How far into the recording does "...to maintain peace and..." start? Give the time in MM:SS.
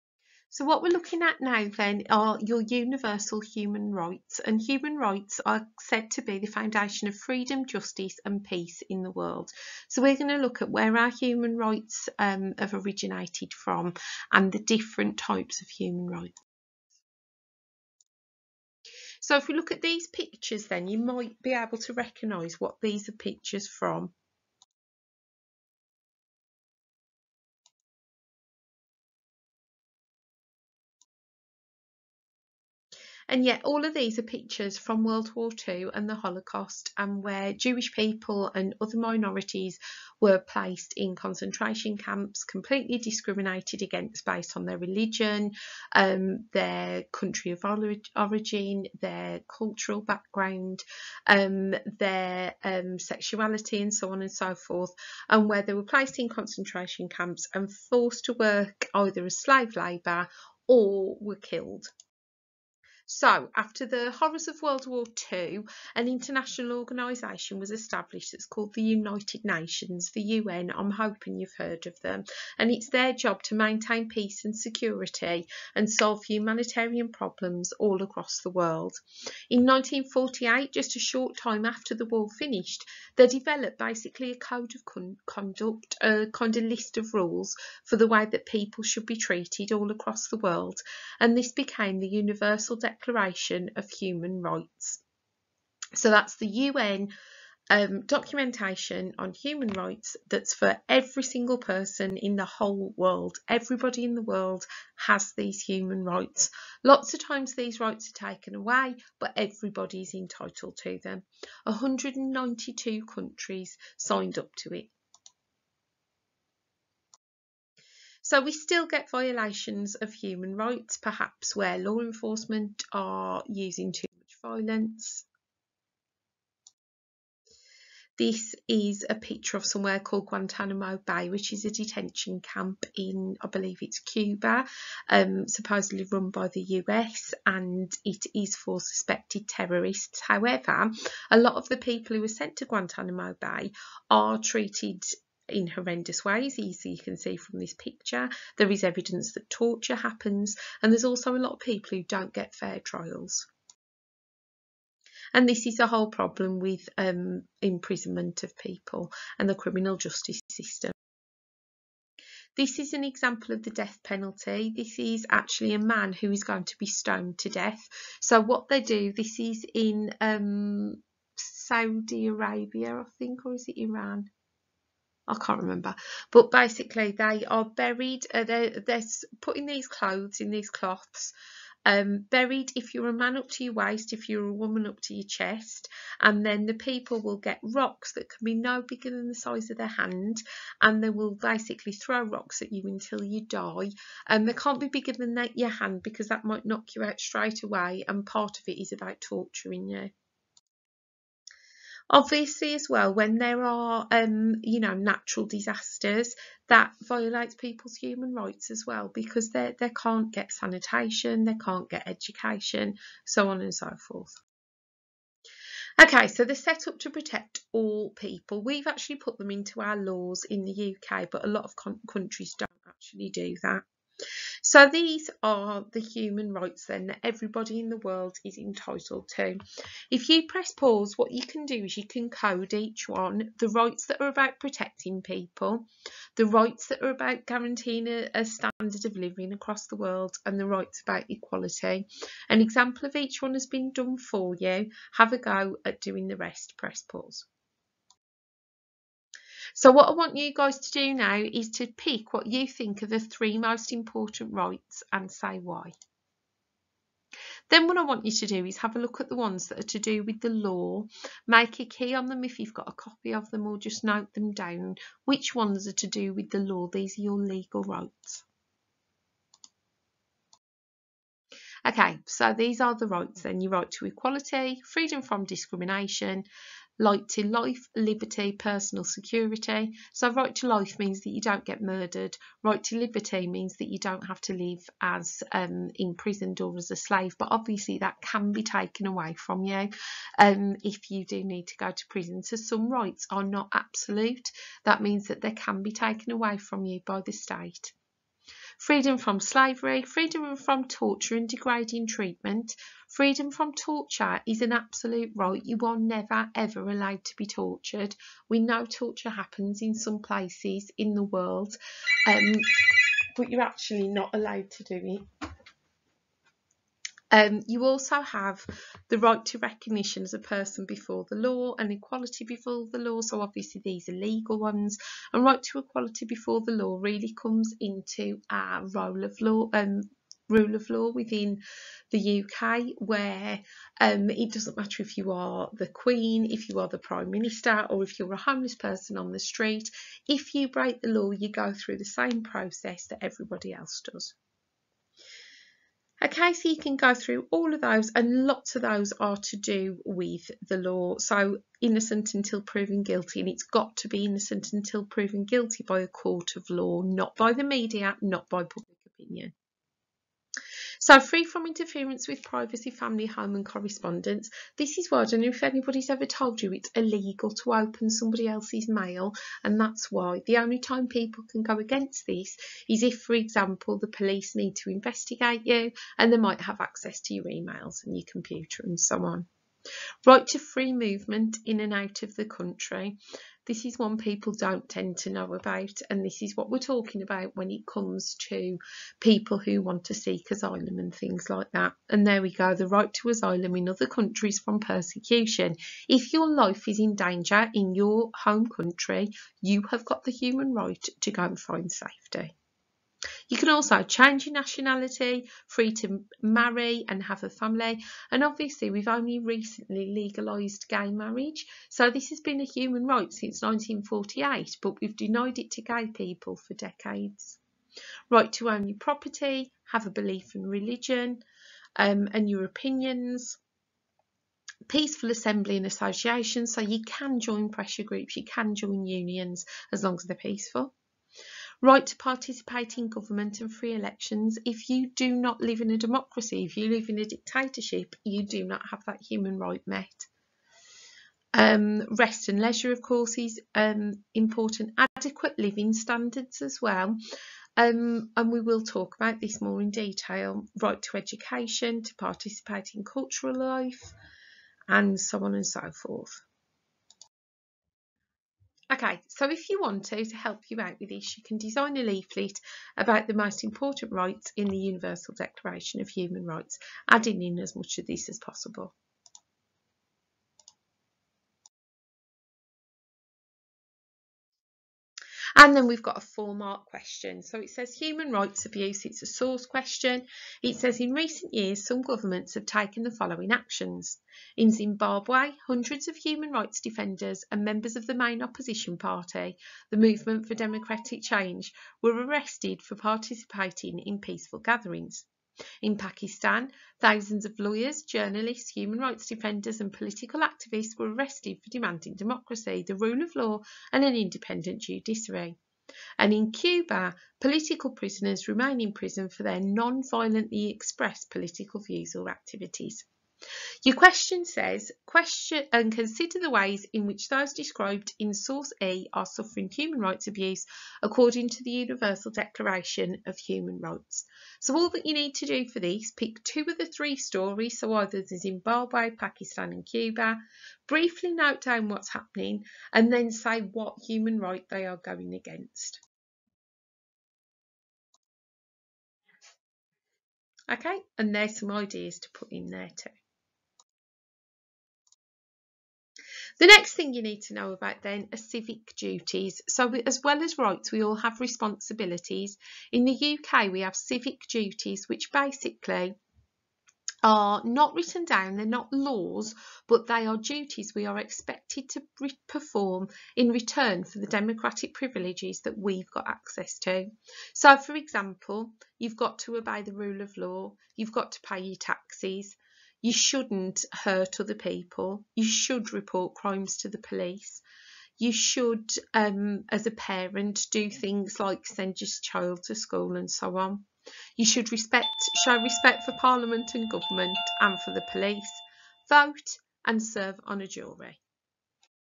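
01:13.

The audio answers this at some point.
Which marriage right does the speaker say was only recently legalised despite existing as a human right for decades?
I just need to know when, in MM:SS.
06:50.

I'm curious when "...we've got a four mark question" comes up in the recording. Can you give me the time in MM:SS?
07:55.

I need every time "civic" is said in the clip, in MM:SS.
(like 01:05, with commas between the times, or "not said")
09:08, 09:13.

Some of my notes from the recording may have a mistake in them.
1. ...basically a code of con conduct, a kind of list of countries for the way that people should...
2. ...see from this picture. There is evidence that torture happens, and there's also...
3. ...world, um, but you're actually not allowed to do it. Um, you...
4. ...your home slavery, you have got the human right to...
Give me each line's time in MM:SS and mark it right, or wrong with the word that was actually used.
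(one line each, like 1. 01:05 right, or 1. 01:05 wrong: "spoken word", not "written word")
1. 01:23 wrong: "rules", not "countries"
2. 02:27 right
3. 05:11 right
4. 06:37 wrong: "country", not "slavery".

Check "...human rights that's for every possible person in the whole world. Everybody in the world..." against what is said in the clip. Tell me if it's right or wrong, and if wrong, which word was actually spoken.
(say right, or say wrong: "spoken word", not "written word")
wrong: "single", not "possible".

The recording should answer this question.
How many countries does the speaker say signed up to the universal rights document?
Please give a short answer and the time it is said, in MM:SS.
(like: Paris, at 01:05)
192, at 01:51.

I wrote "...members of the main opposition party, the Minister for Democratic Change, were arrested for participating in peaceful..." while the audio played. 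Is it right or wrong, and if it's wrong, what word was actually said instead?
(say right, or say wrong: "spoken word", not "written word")
wrong: "Movement", not "Minister".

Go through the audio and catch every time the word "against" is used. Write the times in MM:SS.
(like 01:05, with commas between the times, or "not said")
00:43, 06:11, 08:55.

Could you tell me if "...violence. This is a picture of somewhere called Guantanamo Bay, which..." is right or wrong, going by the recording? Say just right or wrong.
right.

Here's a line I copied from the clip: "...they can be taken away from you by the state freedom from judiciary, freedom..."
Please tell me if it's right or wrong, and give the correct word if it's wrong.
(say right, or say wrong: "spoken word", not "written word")
wrong: "slavery", not "judiciary".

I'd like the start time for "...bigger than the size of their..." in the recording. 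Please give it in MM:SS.
03:08.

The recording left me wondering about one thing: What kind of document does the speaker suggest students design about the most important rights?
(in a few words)
A leaflet.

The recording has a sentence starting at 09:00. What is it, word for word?
Okay, and there's some ideas to put in there too.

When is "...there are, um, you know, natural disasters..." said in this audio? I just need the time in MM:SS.
03:23.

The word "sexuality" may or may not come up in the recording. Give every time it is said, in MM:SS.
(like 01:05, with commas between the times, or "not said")
00:52.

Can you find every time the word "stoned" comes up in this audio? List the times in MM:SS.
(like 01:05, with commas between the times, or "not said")
02:46.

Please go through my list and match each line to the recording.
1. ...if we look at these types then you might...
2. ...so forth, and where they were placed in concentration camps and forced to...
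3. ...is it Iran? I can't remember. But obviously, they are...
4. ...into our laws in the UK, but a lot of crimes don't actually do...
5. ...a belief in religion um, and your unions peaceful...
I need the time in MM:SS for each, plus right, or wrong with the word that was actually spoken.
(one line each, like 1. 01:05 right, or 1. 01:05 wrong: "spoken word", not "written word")
1. 00:19 wrong: "pictures", not "types"
2. 00:54 right
3. 02:53 wrong: "basically", not "obviously"
4. 03:39 wrong: "countries", not "crimes"
5. 07:00 wrong: "opinions", not "unions".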